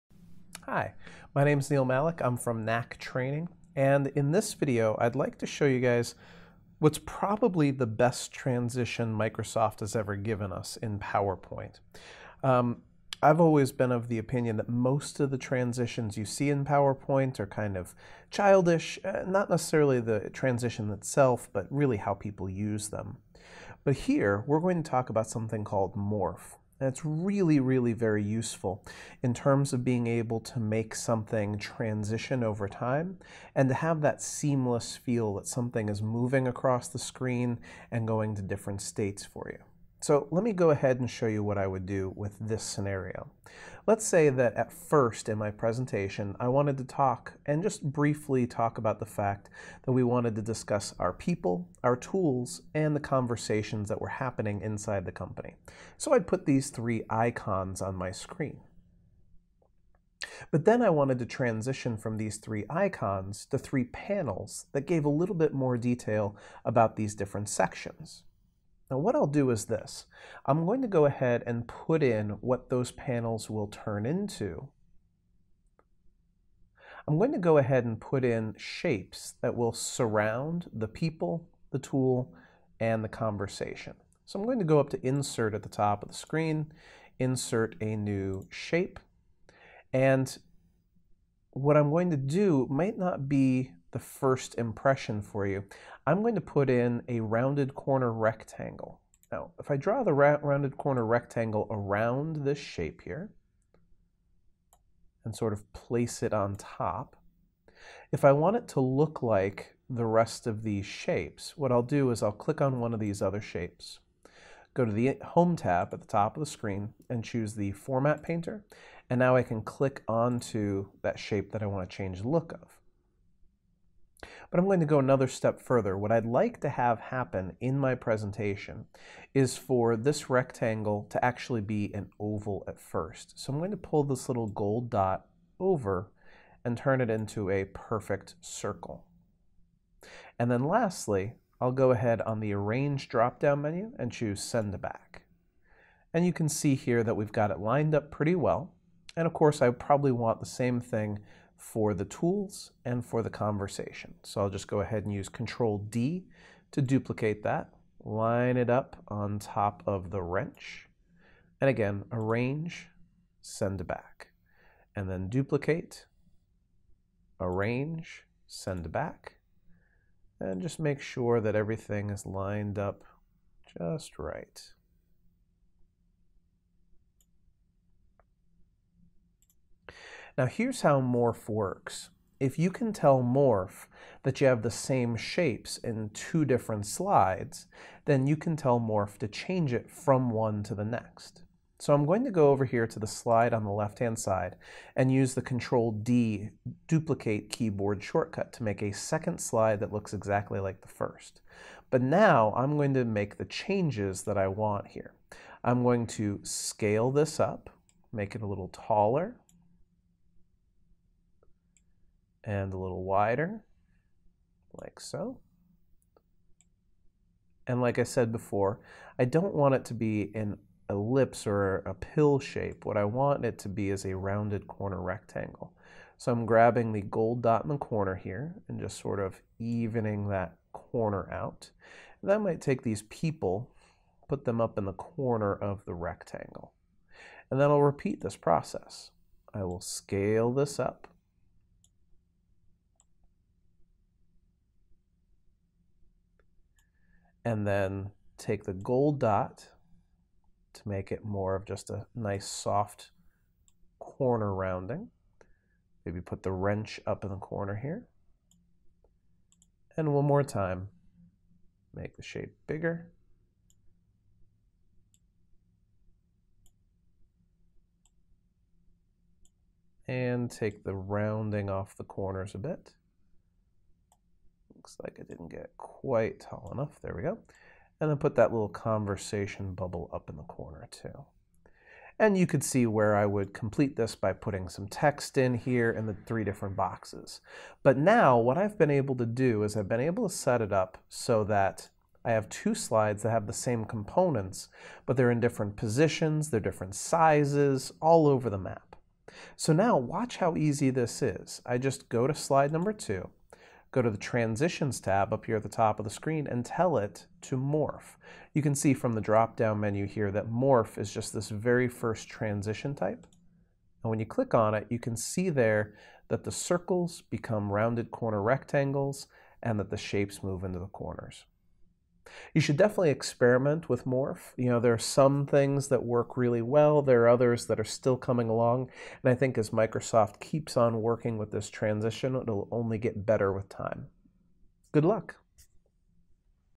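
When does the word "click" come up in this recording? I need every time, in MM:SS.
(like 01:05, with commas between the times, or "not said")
01:52, 01:59, 05:14.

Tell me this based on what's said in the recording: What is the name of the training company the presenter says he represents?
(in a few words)
Knack Training.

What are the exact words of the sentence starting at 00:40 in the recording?
So let me go ahead and show you what I would do with this scenario.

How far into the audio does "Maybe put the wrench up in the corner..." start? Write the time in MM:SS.
04:16.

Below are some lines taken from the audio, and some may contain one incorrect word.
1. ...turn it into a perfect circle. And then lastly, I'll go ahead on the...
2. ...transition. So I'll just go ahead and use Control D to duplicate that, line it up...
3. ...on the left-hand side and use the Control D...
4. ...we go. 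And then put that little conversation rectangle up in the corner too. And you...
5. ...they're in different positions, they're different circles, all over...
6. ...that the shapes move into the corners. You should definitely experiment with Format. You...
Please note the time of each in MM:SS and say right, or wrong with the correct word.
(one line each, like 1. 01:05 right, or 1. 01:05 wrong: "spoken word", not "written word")
1. 02:16 right
2. 02:33 wrong: "conversation", not "transition"
3. 03:13 right
4. 04:37 wrong: "bubble", not "rectangle"
5. 04:55 wrong: "sizes", not "circles"
6. 05:19 wrong: "Morph", not "Format".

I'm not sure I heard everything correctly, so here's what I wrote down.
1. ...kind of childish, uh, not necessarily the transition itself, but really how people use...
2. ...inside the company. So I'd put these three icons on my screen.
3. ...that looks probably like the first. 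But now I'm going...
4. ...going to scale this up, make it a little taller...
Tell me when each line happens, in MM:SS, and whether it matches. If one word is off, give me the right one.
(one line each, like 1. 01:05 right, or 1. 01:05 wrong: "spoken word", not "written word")
1. 00:17 right
2. 00:54 right
3. 03:19 wrong: "exactly", not "probably"
4. 03:25 right.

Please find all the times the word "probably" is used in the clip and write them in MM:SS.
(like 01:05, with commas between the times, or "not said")
00:06, 02:29.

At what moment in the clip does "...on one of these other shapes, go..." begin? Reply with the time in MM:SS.
01:52.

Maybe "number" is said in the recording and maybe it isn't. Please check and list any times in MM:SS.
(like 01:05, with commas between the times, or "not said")
05:02.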